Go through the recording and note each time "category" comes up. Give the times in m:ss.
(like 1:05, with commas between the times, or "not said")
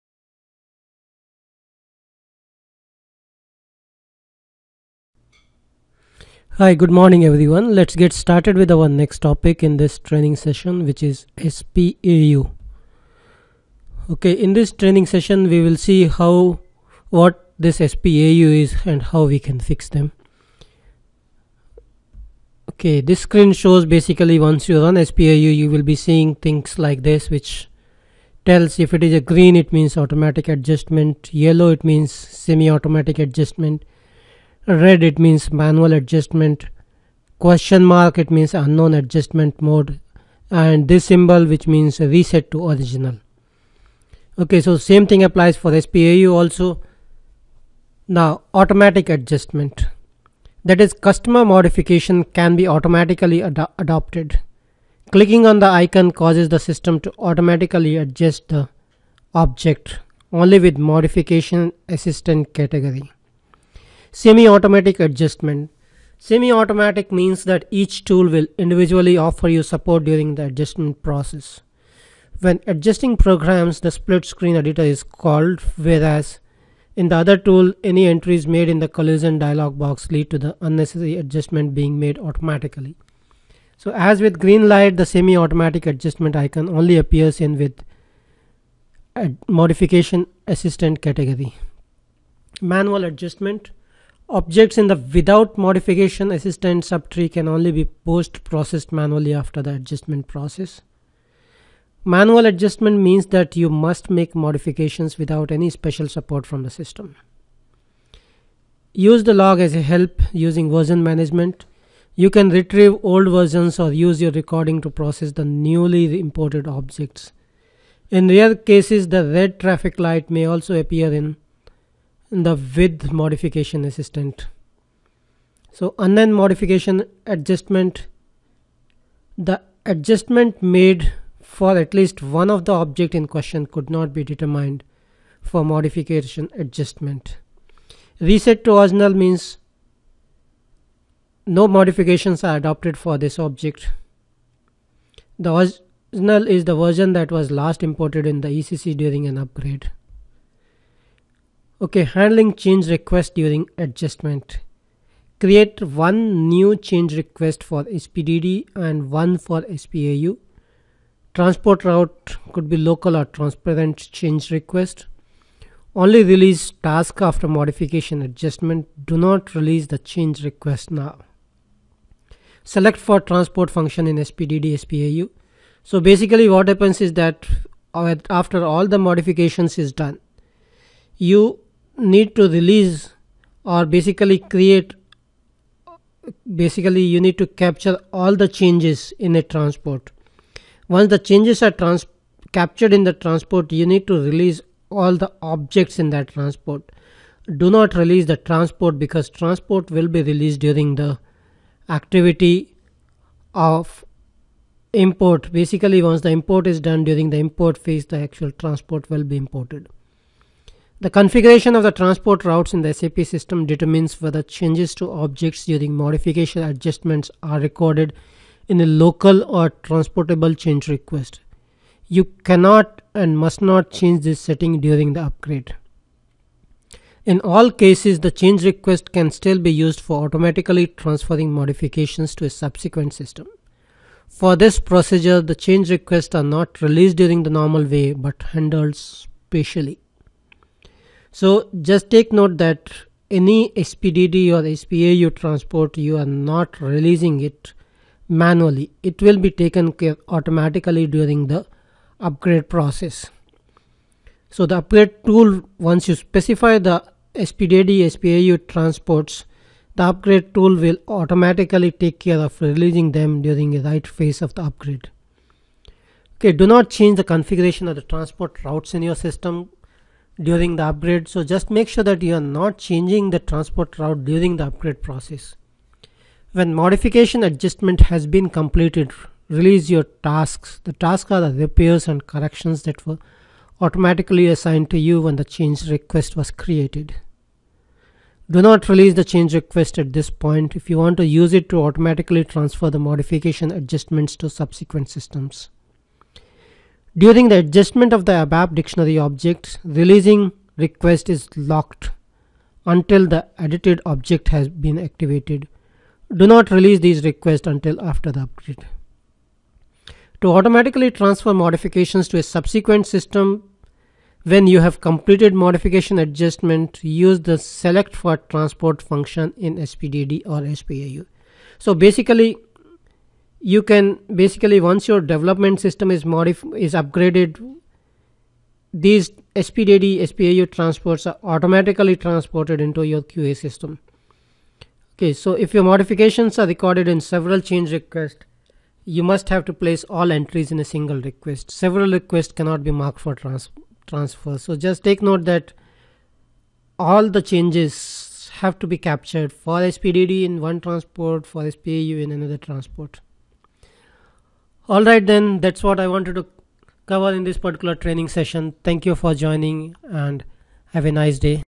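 1:02, 1:31.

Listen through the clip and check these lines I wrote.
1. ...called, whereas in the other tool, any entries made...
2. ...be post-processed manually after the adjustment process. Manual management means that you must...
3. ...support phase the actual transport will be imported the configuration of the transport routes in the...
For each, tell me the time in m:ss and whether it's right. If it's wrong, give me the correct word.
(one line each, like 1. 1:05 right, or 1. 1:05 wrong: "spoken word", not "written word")
1. 1:15 right
2. 1:37 wrong: "adjustment", not "management"
3. 3:27 wrong: "import", not "support".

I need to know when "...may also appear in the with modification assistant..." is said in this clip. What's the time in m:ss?
2:00.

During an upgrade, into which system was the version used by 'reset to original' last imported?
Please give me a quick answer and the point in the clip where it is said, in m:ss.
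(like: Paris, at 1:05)
ECC, at 2:28.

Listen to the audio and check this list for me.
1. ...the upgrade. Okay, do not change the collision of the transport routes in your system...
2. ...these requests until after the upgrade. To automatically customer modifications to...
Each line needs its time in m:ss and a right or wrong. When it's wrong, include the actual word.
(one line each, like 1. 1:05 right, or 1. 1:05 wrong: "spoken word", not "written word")
1. 4:24 wrong: "configuration", not "collision"
2. 5:07 wrong: "transfer", not "customer".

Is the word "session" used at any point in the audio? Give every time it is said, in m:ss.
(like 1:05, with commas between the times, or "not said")
0:10, 0:15, 5:58.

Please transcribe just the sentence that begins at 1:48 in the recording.
Use the log as a help using version management.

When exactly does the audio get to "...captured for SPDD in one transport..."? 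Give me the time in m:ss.
5:48.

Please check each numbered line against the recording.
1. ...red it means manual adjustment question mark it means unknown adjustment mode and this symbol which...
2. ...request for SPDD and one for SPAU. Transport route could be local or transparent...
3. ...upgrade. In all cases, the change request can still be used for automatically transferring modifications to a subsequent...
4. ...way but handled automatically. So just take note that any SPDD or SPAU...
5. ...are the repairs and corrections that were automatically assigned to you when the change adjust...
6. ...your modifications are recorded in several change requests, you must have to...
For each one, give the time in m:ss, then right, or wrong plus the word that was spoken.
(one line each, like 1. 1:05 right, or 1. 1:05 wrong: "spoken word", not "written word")
1. 0:34 right
2. 2:37 right
3. 3:45 right
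4. 3:57 wrong: "spatially", not "automatically"
5. 4:41 wrong: "request", not "adjust"
6. 5:35 right.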